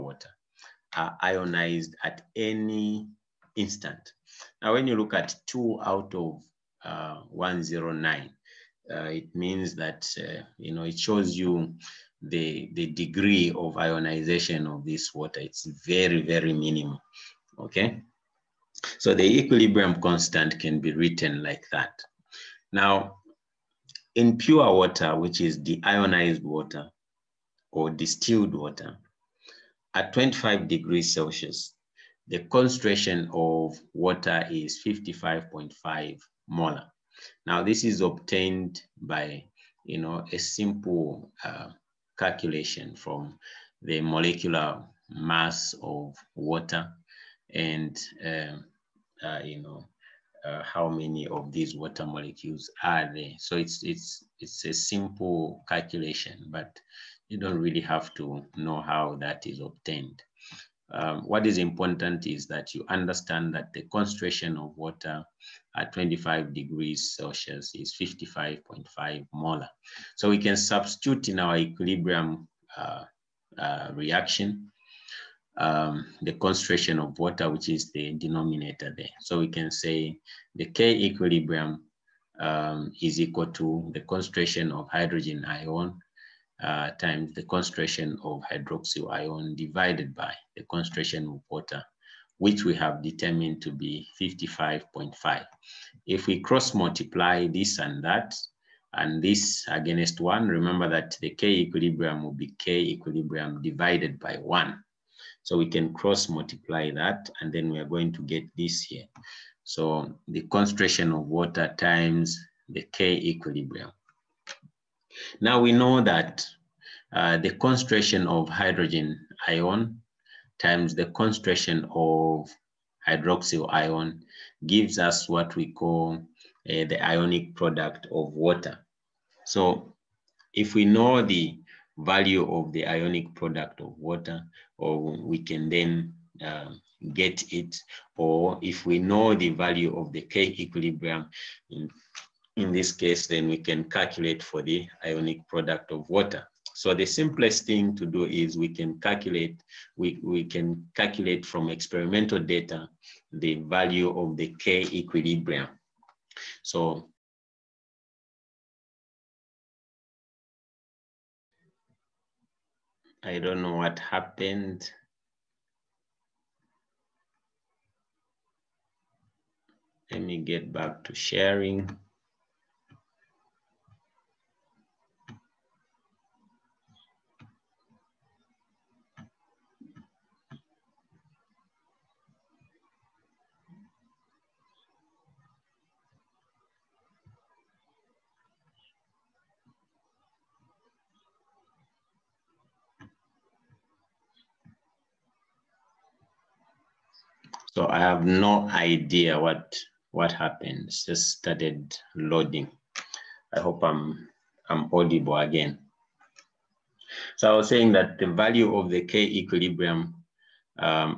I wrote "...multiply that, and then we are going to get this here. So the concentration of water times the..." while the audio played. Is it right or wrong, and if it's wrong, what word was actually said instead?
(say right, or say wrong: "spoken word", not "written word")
right.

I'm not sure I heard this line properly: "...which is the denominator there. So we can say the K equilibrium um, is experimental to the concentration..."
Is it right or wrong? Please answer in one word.
wrong.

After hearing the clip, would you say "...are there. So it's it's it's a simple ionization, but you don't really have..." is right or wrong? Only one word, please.
wrong.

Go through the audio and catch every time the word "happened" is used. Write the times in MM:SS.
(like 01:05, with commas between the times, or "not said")
02:43, 03:20.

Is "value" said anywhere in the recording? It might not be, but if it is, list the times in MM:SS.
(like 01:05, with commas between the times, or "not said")
02:11, 02:19, 02:33, 03:28.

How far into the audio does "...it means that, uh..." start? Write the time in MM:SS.
00:09.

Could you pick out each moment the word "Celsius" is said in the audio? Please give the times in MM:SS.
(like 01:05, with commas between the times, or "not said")
00:31, 01:07.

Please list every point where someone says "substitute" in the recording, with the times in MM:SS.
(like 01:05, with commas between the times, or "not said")
01:10.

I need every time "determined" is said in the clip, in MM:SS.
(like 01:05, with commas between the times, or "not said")
01:33.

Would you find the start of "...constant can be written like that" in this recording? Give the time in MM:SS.
00:20.